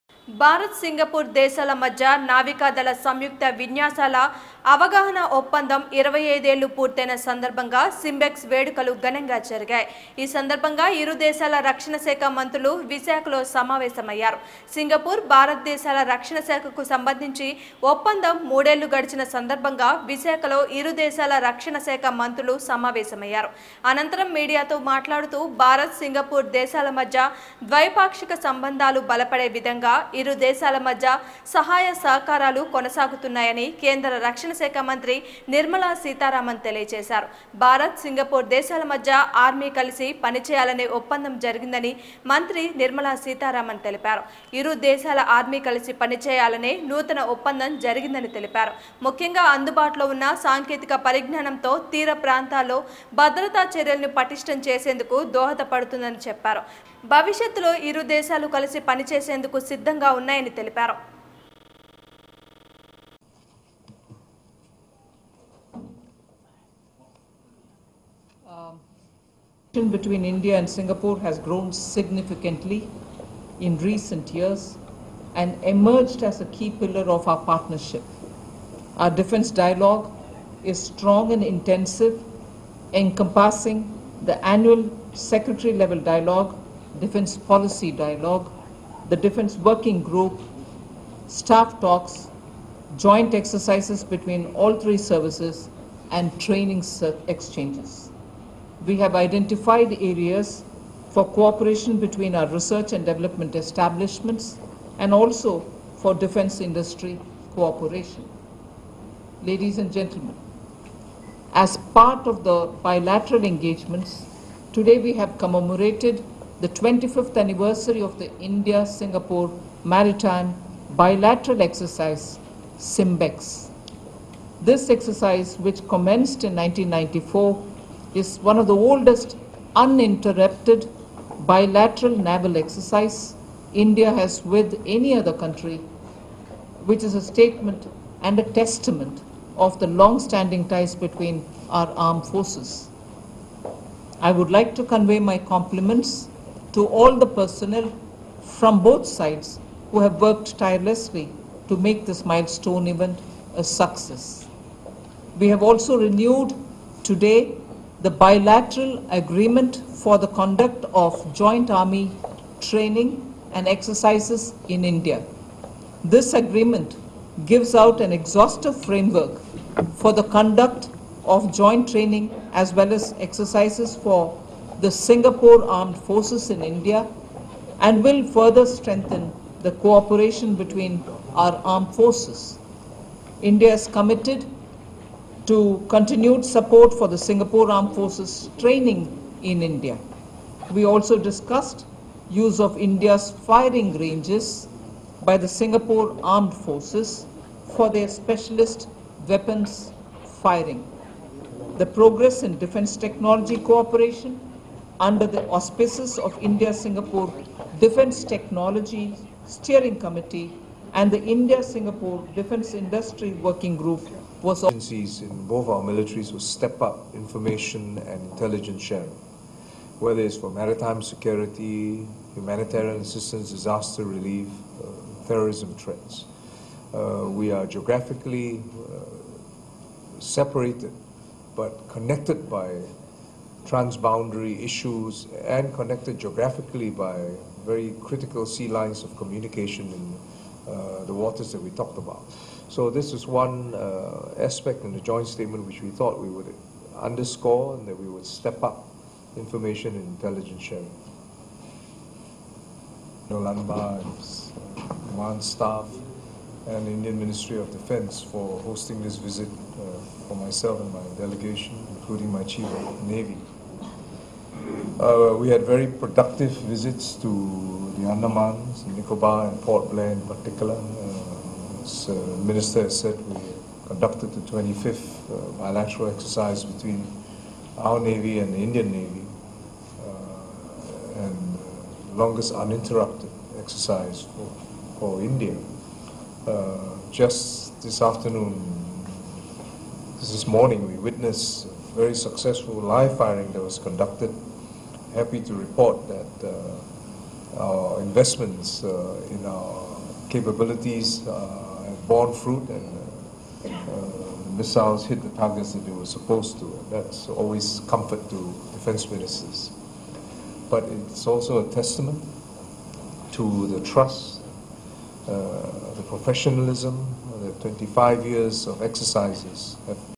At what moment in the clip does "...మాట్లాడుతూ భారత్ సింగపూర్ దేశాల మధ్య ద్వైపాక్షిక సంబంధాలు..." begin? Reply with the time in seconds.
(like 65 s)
24 s.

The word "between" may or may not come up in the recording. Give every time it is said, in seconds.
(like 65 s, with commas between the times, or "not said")
69 s, 94 s, 102 s, 140 s, 180 s, 276 s.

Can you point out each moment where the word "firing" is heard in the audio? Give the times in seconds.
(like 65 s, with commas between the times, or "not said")
193 s, 200 s, 293 s.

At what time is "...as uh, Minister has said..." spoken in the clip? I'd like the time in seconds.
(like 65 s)
271 s.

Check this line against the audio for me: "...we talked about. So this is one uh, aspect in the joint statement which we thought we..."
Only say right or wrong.
right.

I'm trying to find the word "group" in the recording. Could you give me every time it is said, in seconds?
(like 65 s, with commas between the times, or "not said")
90 s, 213 s.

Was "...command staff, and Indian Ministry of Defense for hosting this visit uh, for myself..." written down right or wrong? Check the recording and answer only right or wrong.
right.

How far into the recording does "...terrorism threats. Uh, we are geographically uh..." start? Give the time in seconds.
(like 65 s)
225 s.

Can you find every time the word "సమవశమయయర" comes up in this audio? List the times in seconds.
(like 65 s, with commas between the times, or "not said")
13 s, 22 s.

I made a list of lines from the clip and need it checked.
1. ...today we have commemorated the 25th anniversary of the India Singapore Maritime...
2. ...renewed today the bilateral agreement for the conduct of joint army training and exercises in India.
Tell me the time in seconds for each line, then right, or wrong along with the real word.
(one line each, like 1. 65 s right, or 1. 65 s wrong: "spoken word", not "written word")
1. 114 s right
2. 155 s right.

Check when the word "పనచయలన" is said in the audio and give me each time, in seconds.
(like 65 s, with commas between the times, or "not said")
40 s, 46 s.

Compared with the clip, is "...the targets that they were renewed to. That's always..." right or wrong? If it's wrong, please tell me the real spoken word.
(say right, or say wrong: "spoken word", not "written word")
wrong: "supposed", not "renewed".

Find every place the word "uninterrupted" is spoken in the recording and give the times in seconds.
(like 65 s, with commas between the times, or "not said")
129 s, 282 s.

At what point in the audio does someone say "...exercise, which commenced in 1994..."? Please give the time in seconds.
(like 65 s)
124 s.